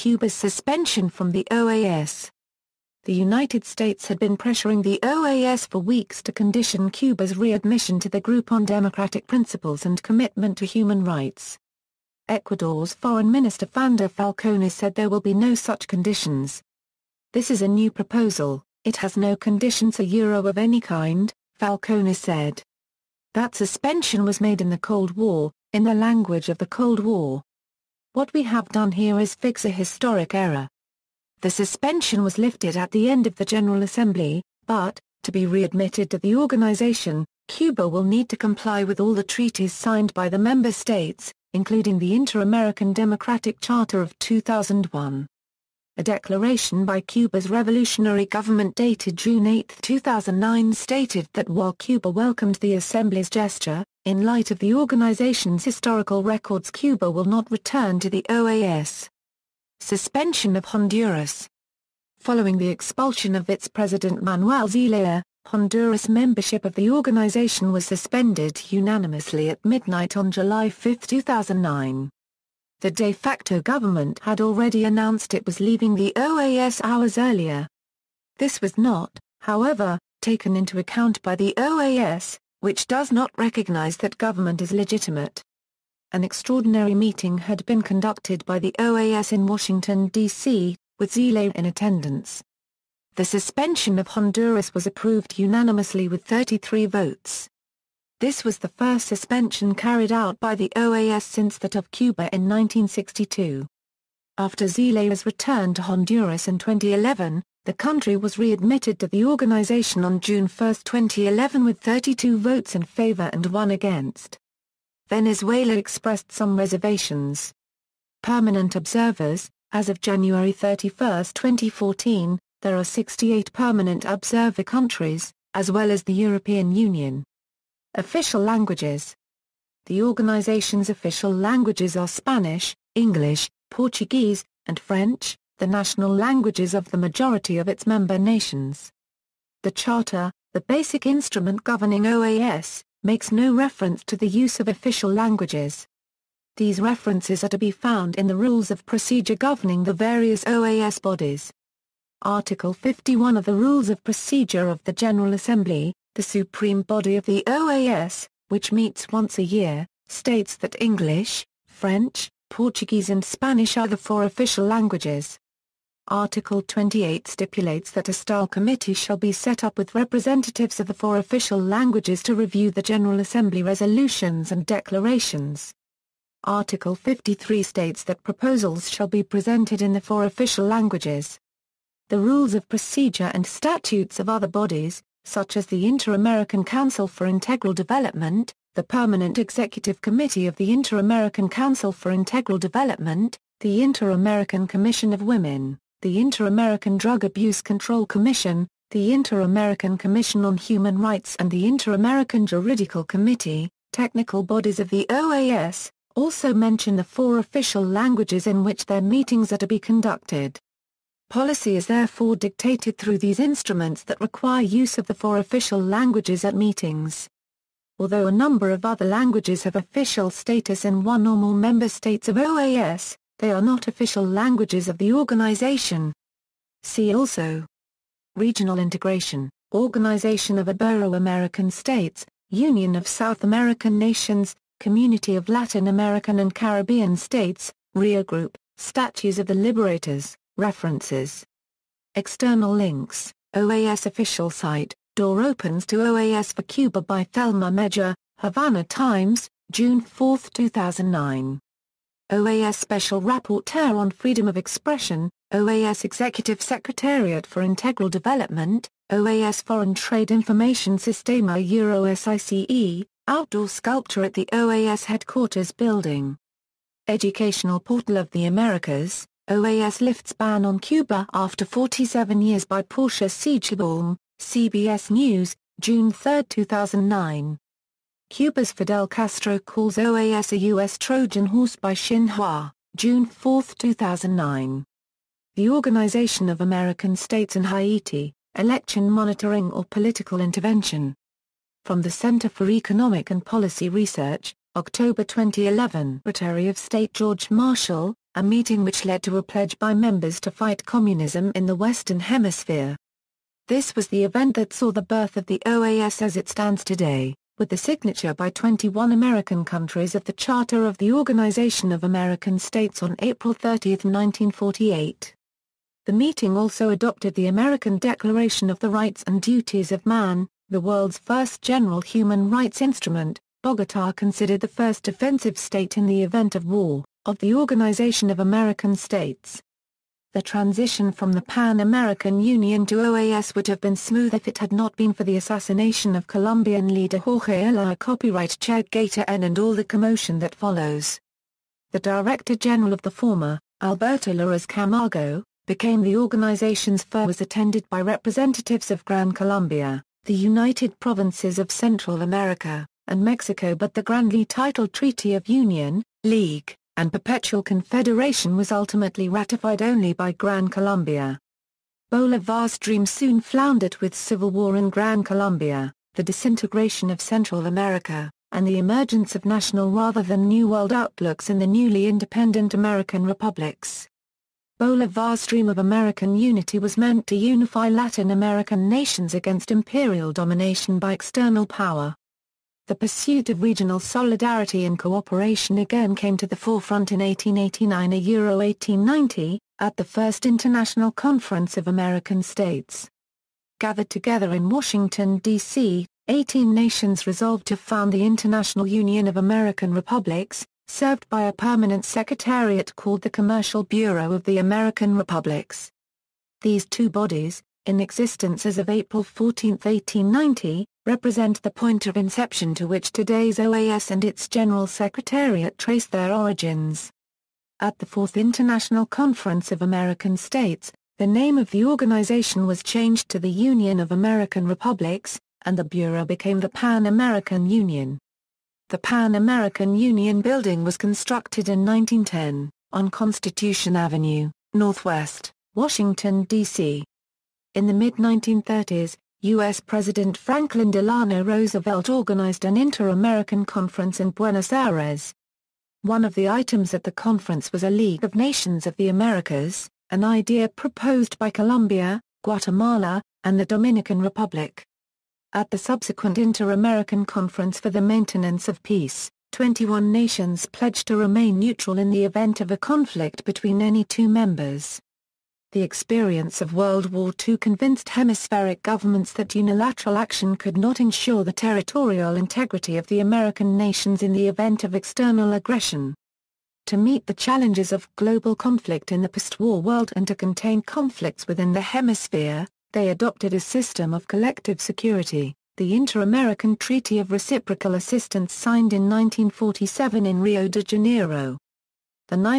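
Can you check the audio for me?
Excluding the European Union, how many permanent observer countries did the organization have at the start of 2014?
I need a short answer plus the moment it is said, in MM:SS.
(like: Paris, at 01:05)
68, at 02:02.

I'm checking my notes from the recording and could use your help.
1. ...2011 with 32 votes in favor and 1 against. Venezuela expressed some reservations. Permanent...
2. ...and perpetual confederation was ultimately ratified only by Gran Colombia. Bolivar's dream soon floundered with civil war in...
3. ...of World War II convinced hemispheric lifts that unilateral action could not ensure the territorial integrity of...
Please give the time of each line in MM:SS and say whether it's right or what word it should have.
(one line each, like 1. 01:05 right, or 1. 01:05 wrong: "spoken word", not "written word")
1. 01:50 right
2. 05:56 right
3. 07:46 wrong: "governments", not "lifts".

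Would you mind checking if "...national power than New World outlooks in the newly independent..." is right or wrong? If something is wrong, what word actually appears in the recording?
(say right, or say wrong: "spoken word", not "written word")
wrong: "rather", not "power".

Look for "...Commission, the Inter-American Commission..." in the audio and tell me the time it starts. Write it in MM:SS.
03:18.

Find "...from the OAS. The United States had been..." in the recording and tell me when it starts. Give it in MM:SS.
00:01.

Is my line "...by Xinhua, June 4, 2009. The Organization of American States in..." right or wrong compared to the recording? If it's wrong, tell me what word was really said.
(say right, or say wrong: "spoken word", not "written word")
right.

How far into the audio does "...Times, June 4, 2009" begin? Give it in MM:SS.
04:08.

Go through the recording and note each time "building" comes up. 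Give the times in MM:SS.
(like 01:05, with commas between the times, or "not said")
04:25, 07:10.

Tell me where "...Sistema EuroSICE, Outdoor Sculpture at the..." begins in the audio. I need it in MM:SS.
04:20.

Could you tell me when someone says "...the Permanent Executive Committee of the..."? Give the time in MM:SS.
03:08.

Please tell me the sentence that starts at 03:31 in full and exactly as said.
Policy is therefore dictated through these instruments that require use of the four official languages at meetings.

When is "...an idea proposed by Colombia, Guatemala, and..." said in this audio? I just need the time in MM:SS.
07:30.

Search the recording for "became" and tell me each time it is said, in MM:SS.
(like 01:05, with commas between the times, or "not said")
05:45, 07:06.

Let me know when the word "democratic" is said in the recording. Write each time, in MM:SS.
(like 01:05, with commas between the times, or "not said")
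00:08, 00:42.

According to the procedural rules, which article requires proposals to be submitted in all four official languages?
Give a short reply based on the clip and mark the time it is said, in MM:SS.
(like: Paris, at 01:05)
Article 53, at 02:56.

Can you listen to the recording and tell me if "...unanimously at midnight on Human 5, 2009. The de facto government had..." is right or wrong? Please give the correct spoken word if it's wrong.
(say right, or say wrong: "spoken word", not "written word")
wrong: "July", not "Human".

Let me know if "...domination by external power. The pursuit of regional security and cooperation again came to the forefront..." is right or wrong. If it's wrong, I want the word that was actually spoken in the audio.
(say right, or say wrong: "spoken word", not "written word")
wrong: "solidarity", not "security".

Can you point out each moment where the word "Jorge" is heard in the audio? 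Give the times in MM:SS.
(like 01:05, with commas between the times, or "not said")
05:37.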